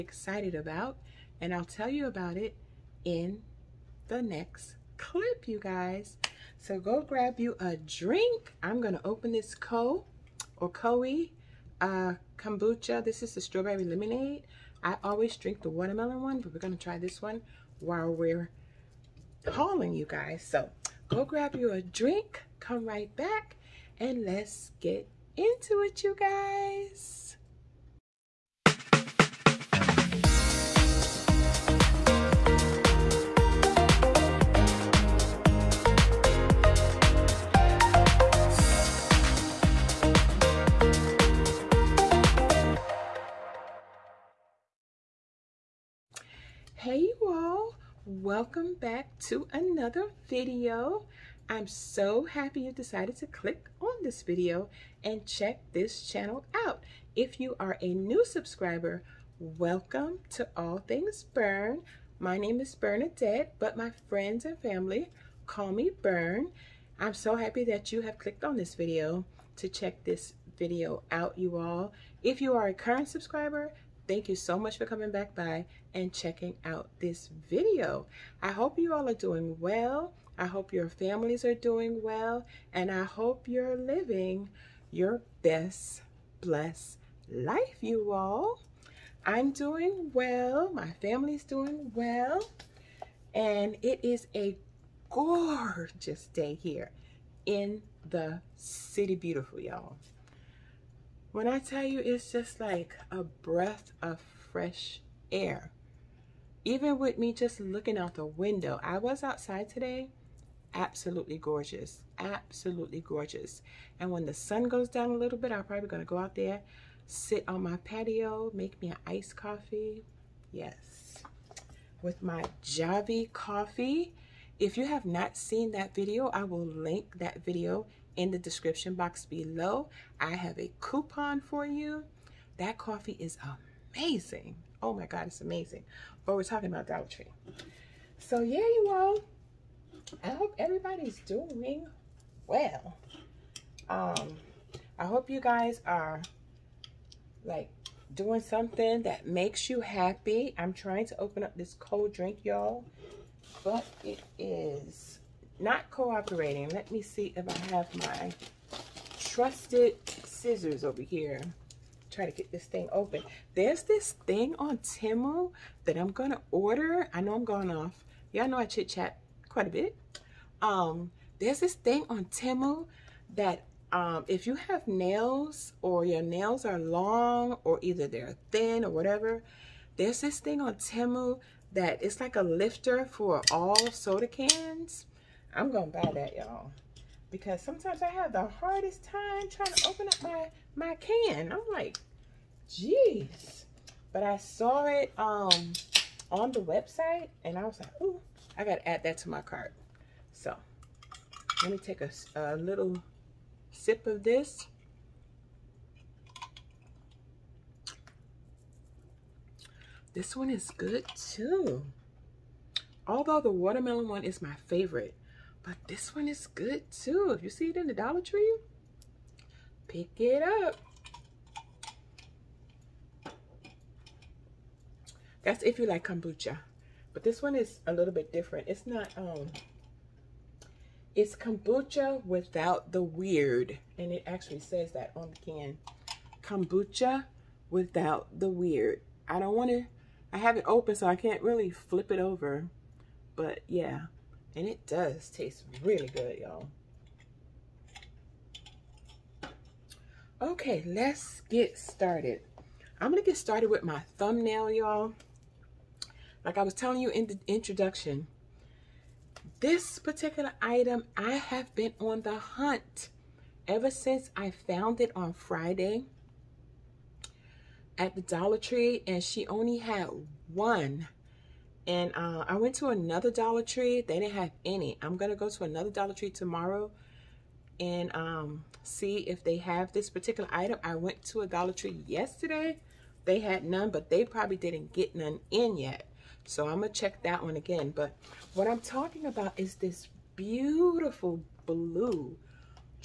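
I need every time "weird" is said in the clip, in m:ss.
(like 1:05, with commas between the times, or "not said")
3:53, 3:58.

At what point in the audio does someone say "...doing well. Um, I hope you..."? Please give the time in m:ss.
2:21.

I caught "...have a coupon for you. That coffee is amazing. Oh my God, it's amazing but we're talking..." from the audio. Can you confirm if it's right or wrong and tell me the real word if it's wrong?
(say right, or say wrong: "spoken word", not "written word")
right.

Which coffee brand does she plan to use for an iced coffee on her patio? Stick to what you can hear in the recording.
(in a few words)
Javy.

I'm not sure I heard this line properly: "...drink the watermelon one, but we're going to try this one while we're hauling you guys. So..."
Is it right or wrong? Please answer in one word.
right.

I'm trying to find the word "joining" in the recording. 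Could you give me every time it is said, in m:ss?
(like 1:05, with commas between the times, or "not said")
not said.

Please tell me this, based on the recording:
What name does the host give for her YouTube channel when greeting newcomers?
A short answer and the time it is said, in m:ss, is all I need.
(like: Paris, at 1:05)
All Things Bern, at 1:00.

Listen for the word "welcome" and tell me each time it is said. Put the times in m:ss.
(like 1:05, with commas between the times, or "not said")
0:48, 0:59.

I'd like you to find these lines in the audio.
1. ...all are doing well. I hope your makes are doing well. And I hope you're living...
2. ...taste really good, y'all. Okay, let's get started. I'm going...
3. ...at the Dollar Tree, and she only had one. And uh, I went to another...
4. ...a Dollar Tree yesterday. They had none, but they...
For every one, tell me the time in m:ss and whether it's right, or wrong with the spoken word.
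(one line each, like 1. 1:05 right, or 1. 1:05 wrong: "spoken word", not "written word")
1. 1:18 wrong: "families", not "makes"
2. 4:05 right
3. 4:27 right
4. 4:41 right.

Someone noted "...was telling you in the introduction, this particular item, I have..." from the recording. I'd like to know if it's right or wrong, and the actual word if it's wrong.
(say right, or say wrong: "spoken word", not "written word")
right.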